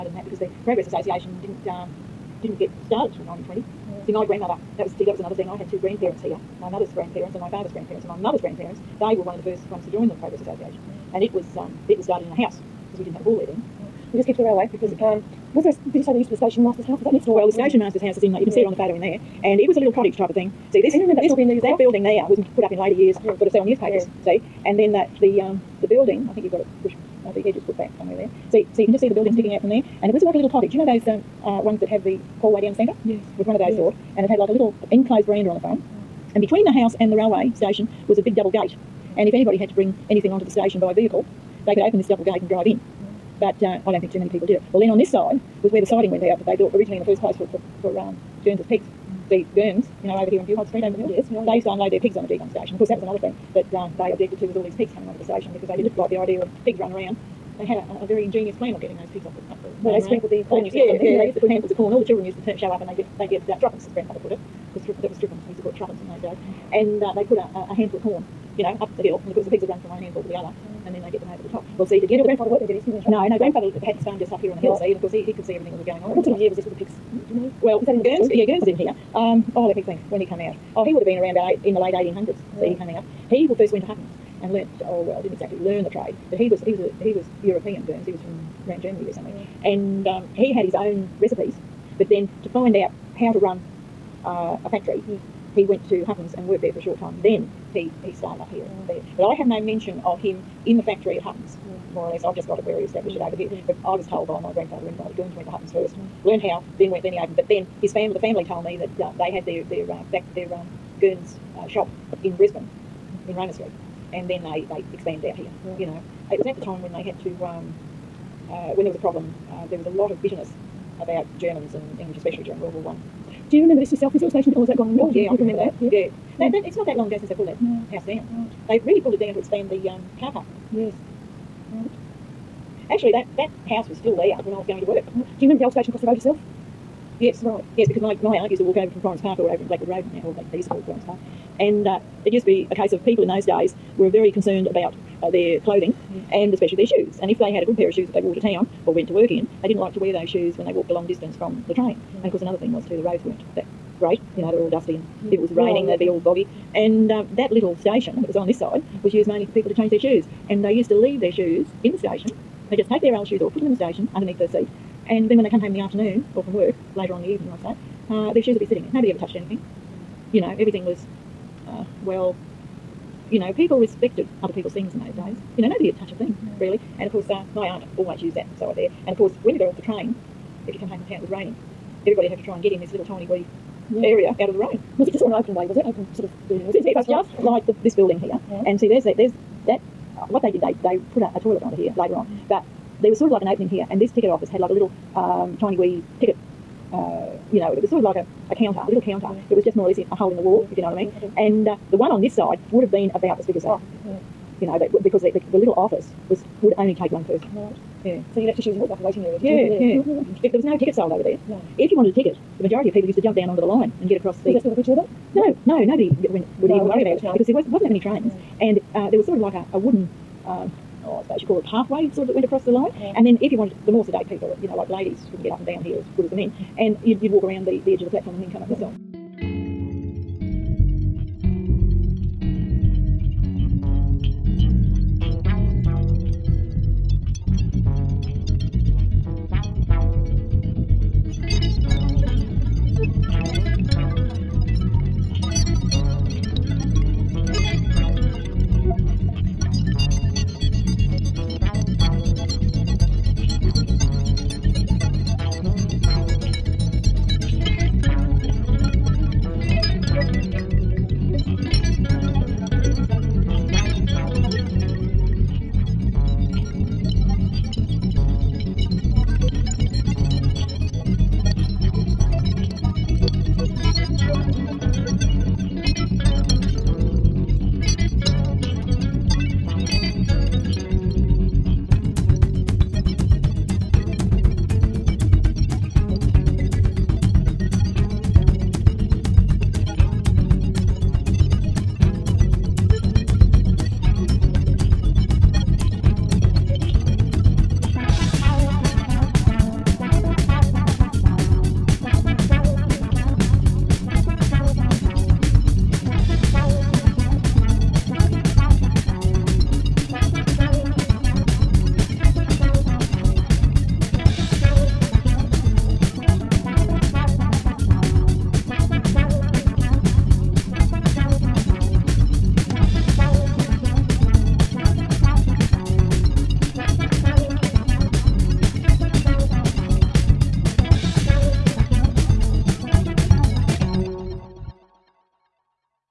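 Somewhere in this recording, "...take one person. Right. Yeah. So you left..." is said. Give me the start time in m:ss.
3:26.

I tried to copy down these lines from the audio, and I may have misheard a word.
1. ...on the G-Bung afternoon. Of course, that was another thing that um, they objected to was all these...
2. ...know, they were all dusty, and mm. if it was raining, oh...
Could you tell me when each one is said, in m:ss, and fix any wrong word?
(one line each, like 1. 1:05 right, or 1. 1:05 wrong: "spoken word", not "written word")
1. 0:52 wrong: "station", not "afternoon"
2. 2:34 right.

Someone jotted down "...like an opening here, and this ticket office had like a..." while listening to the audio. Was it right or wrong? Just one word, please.
right.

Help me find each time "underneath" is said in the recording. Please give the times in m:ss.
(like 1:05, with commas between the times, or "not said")
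2:44.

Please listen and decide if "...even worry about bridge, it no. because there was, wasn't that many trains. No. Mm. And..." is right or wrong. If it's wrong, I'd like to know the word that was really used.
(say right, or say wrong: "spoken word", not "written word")
right.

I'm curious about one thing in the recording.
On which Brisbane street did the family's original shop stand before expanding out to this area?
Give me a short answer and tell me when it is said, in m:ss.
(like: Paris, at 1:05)
Roma Street, at 1:53.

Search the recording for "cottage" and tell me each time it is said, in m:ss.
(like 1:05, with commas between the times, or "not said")
0:19, 0:30.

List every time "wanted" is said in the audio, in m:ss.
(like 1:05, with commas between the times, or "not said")
3:31, 3:43.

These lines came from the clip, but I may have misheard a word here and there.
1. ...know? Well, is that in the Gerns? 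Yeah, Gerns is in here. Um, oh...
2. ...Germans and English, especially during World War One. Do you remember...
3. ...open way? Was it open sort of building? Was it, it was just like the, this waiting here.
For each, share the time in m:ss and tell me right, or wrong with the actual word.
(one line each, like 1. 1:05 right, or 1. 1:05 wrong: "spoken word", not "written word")
1. 1:17 right
2. 2:01 right
3. 3:05 wrong: "building", not "waiting".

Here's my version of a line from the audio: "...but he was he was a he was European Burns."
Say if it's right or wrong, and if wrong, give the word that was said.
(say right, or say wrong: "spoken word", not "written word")
right.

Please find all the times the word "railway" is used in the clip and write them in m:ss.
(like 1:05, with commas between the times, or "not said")
0:14, 0:37.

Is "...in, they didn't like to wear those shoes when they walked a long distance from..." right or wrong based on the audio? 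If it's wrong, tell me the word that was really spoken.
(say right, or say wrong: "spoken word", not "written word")
right.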